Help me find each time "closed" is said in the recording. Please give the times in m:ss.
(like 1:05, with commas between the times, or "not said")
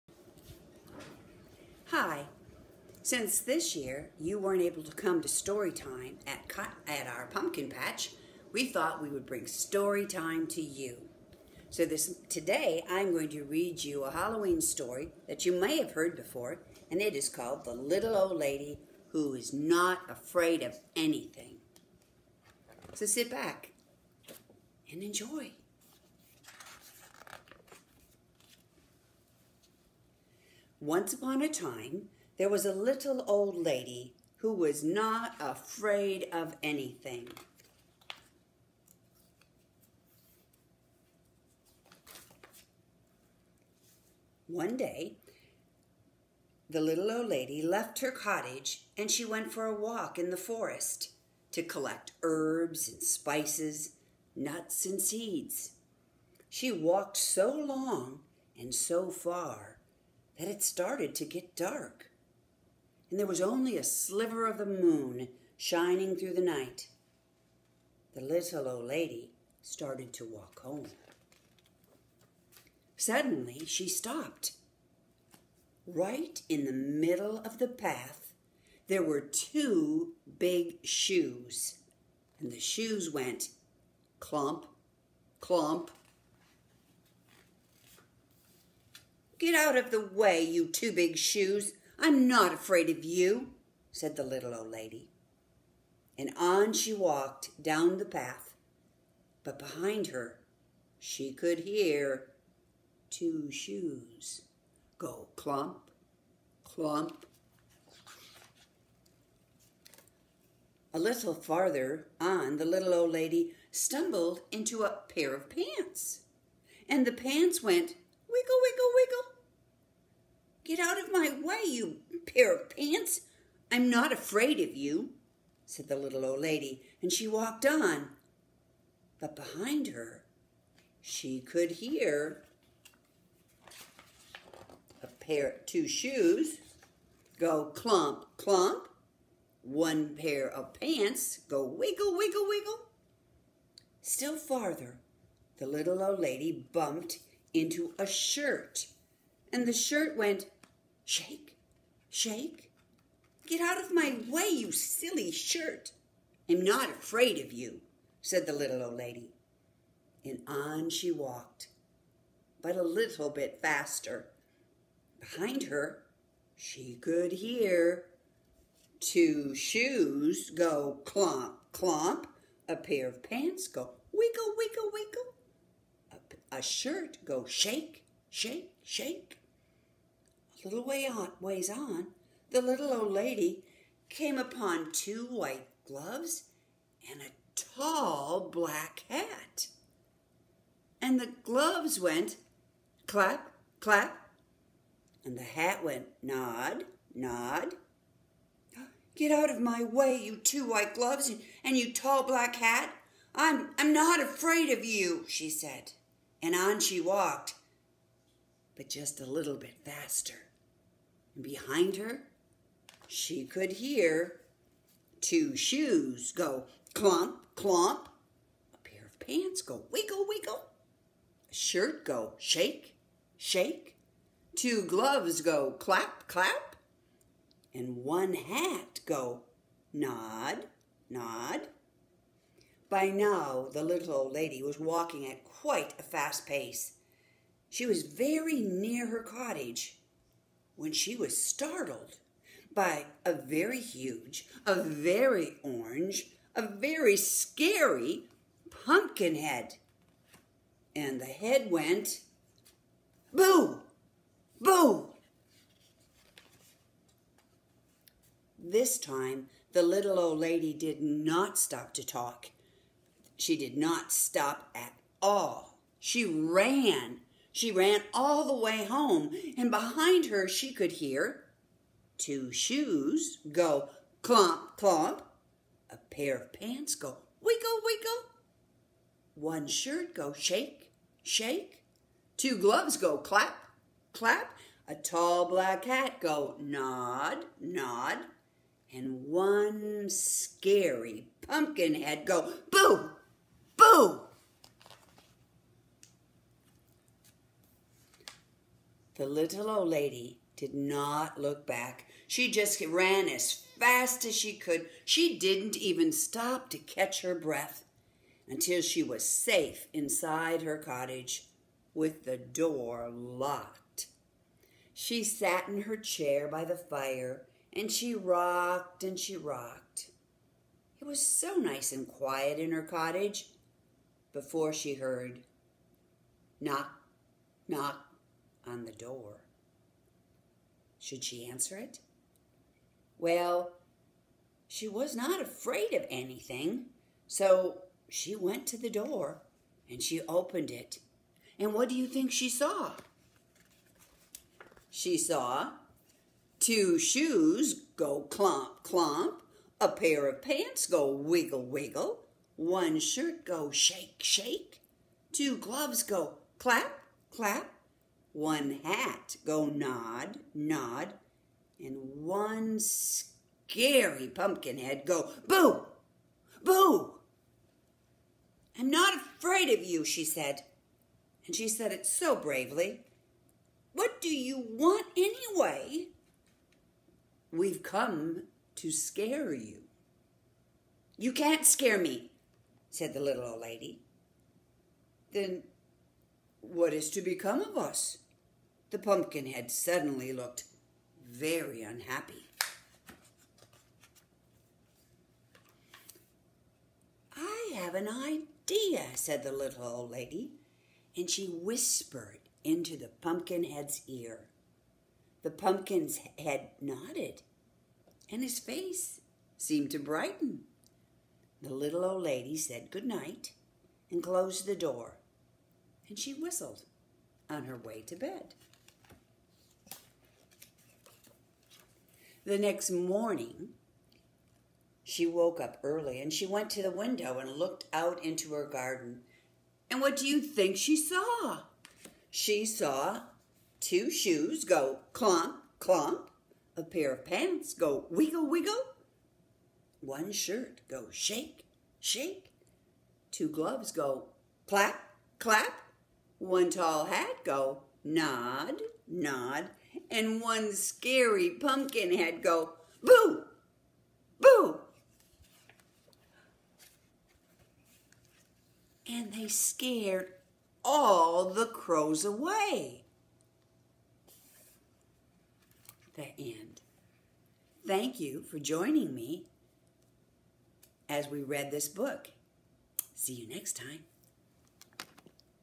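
6:54.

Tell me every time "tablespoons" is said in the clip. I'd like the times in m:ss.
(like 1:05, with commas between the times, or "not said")
not said.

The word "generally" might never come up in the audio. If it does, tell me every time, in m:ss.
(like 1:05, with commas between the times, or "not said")
not said.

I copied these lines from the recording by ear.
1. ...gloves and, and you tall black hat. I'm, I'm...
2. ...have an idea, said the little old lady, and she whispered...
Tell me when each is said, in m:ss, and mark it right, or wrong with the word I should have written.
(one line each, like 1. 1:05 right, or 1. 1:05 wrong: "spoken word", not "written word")
1. 3:20 right
2. 6:37 right.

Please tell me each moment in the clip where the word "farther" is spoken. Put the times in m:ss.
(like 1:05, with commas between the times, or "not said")
1:51, 2:24.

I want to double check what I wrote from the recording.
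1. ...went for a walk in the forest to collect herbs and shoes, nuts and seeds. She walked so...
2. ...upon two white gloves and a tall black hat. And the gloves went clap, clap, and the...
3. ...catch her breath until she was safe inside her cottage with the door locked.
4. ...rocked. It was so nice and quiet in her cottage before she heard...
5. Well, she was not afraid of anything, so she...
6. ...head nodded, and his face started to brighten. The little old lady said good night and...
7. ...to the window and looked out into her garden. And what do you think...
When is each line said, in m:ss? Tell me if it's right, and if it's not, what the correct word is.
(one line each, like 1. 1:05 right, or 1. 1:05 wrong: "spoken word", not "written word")
1. 0:49 wrong: "spices", not "shoes"
2. 3:04 right
3. 5:06 right
4. 5:19 right
5. 5:33 right
6. 6:46 wrong: "seemed", not "started"
7. 7:06 right.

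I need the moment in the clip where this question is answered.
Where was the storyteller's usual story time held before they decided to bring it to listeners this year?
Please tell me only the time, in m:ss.
0:07.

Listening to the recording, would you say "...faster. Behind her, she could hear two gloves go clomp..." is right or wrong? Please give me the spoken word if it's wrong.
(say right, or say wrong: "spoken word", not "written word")
wrong: "shoes", not "gloves".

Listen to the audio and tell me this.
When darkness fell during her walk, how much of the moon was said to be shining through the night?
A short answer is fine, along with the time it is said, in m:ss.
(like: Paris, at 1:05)
a sliver, at 1:03.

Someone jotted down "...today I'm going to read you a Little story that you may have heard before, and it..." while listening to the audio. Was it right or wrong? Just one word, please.
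wrong.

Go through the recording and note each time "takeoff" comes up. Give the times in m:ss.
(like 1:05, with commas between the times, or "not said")
not said.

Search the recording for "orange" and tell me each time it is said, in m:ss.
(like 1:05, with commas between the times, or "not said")
4:05.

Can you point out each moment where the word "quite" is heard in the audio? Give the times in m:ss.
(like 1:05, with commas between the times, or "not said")
3:55.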